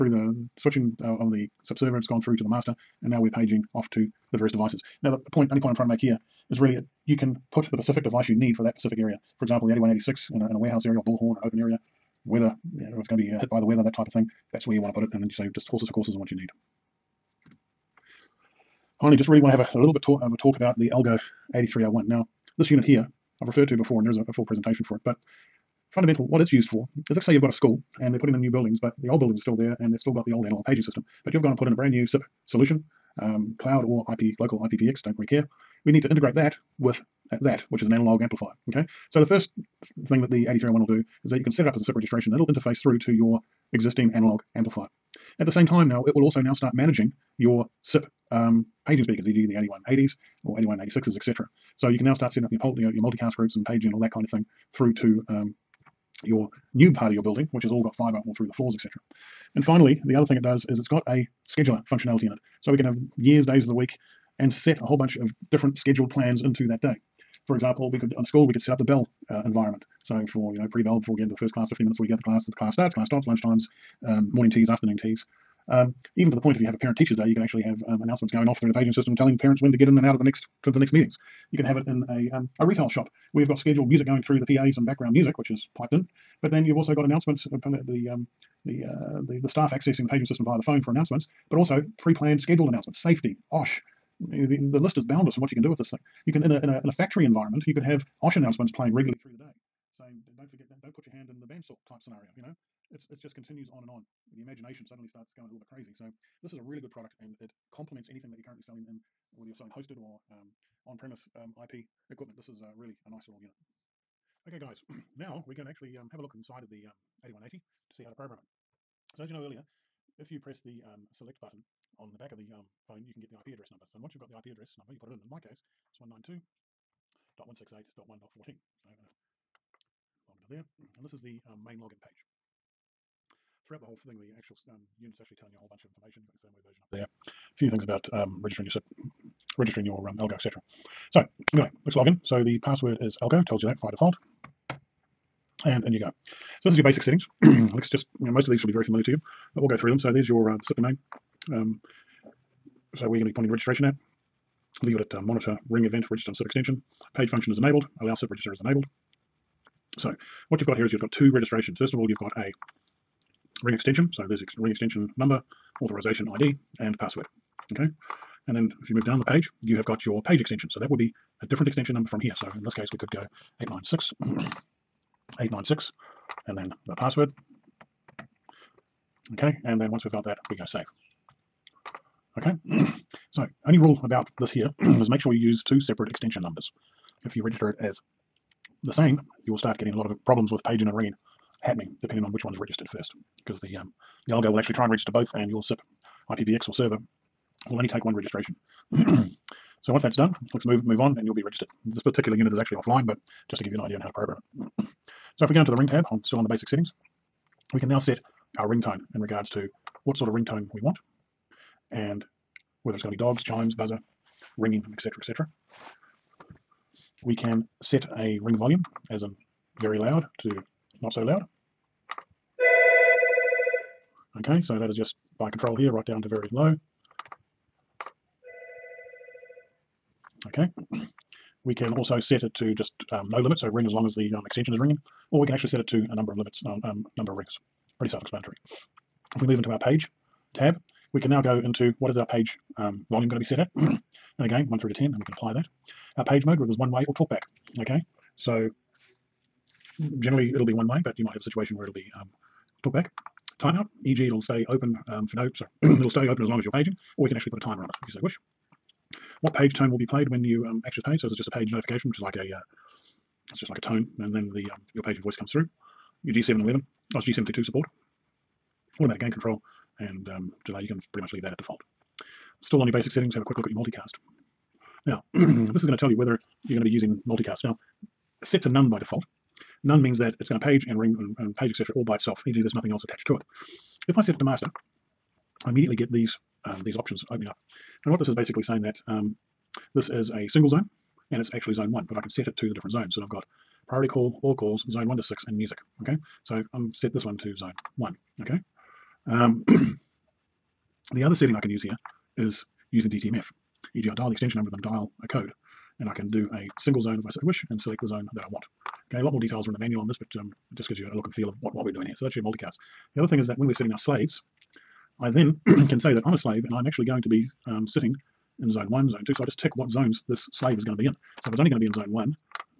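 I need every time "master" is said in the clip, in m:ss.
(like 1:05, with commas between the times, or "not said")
0:02, 4:44.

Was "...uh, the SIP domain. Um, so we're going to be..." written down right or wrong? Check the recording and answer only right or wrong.
right.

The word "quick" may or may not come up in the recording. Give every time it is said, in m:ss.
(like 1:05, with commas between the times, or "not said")
4:33.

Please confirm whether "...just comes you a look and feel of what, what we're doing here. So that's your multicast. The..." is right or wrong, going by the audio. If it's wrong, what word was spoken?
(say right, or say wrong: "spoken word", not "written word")
wrong: "gives", not "comes".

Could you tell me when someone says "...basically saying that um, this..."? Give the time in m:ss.
4:48.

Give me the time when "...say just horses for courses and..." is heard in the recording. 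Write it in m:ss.
0:15.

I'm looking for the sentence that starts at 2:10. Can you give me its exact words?
And this is the um, main login page.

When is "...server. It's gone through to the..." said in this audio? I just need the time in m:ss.
0:01.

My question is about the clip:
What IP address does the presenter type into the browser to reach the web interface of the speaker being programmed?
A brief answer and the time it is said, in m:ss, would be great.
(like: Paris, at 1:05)
192.168.1.14, at 2:05.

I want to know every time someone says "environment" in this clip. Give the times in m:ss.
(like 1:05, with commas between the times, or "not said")
1:09, 1:37.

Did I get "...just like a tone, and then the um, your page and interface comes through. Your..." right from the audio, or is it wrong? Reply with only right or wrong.
wrong.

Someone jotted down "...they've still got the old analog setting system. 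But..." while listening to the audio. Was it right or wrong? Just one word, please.
wrong.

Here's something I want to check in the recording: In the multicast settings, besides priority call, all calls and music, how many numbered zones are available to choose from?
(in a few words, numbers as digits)
6.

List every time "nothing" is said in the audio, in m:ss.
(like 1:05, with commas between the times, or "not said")
4:42.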